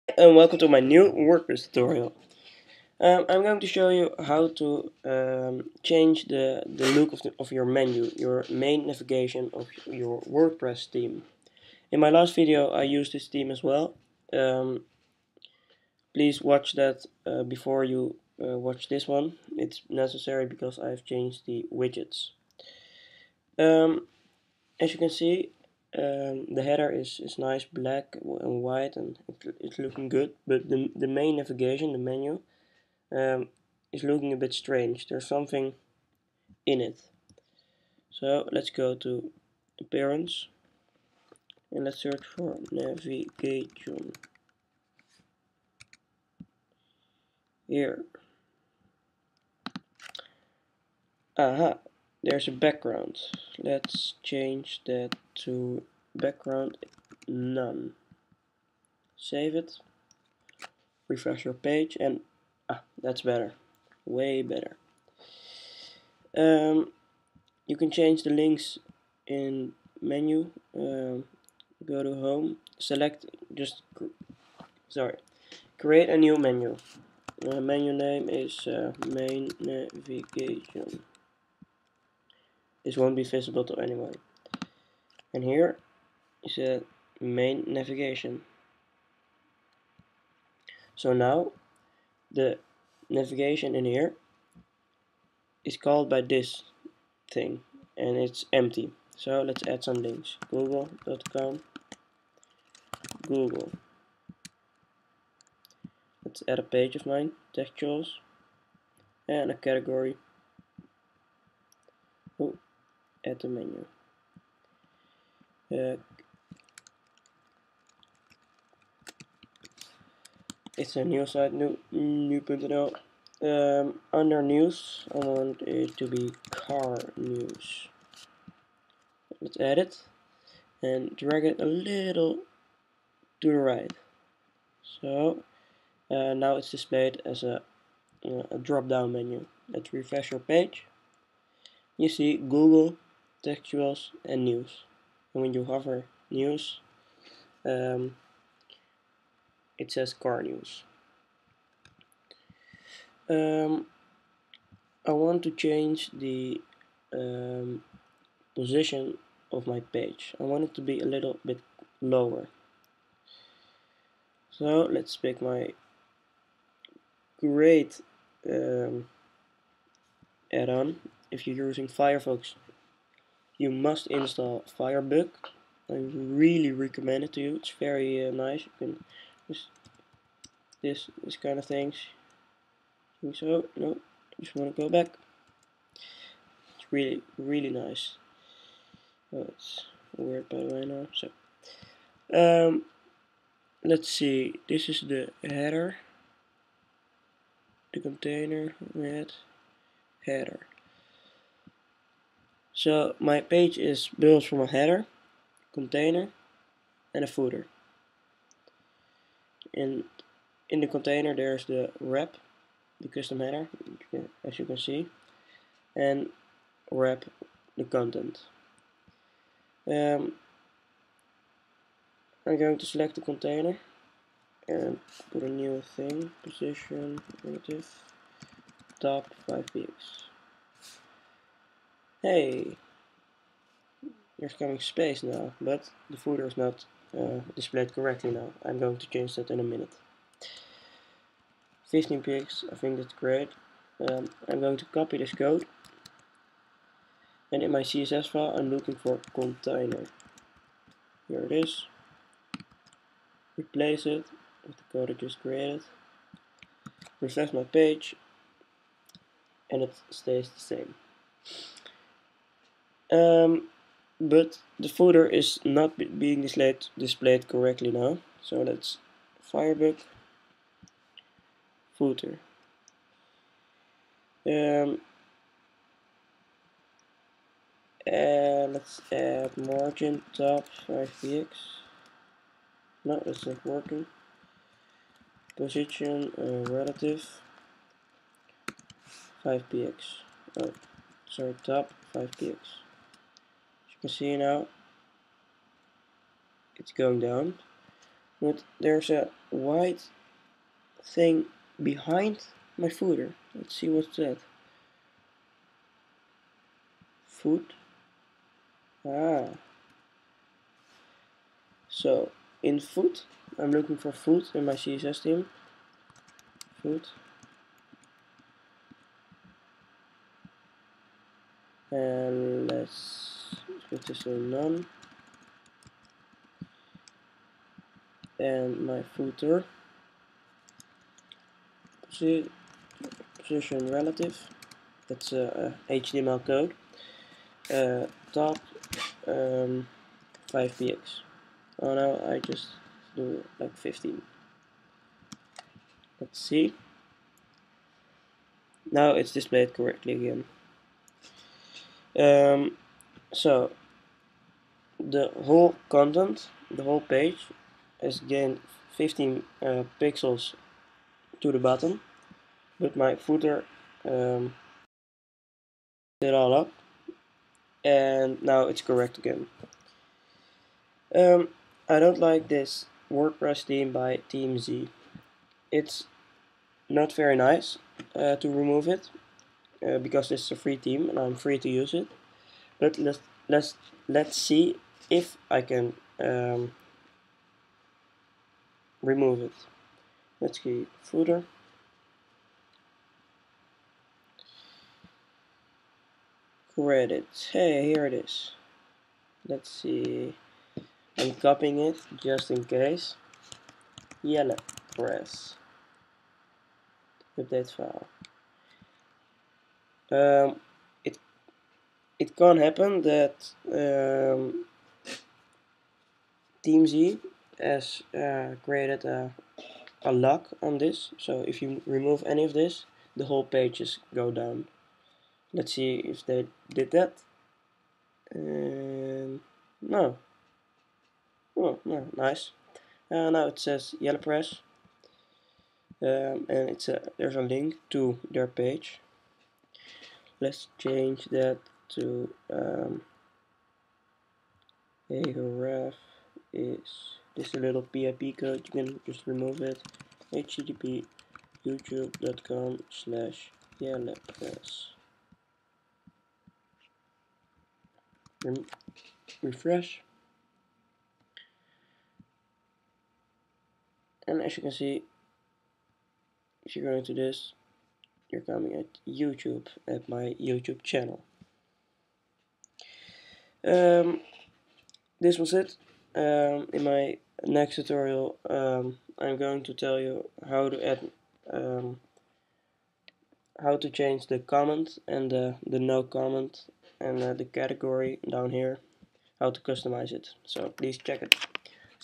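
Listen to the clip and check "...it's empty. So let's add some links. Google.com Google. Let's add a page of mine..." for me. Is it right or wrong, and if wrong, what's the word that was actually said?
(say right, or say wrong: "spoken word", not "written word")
right.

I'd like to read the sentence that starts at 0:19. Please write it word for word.
It's necessary because I've changed the widgets.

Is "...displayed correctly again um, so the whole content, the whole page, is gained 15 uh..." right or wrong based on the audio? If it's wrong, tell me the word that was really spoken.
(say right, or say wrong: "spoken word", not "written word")
right.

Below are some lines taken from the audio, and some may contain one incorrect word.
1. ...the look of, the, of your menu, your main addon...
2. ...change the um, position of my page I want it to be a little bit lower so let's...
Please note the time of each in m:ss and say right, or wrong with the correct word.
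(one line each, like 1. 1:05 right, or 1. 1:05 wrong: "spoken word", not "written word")
1. 0:06 wrong: "navigation", not "addon"
2. 2:35 right.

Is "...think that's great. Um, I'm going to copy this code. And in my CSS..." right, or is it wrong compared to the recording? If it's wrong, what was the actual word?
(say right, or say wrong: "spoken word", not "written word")
right.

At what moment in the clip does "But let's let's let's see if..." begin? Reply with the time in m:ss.
6:22.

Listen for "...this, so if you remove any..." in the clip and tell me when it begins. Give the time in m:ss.
7:00.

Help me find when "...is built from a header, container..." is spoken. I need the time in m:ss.
3:23.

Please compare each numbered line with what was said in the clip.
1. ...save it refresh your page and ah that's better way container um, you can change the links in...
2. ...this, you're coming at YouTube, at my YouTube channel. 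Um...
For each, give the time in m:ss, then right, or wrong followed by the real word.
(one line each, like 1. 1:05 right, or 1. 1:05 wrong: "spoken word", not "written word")
1. 0:59 wrong: "better", not "container"
2. 7:47 right.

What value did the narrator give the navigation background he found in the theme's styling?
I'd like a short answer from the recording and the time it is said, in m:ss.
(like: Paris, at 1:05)
background none, at 0:56.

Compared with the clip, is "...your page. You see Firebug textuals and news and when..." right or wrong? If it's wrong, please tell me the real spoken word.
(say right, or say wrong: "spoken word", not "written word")
wrong: "Google", not "Firebug".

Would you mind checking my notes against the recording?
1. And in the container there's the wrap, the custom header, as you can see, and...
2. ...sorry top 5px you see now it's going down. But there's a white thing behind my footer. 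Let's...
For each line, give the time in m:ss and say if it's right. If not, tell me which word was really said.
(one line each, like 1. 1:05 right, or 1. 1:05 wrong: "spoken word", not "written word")
1. 3:29 right
2. 4:51 right.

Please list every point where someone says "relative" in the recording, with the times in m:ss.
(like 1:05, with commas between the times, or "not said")
3:47, 4:46, 5:33.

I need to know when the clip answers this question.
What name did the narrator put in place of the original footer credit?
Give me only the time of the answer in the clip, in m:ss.
7:14.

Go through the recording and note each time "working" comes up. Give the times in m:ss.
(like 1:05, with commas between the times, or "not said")
4:43.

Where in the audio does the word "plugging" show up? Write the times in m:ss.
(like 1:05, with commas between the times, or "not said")
not said.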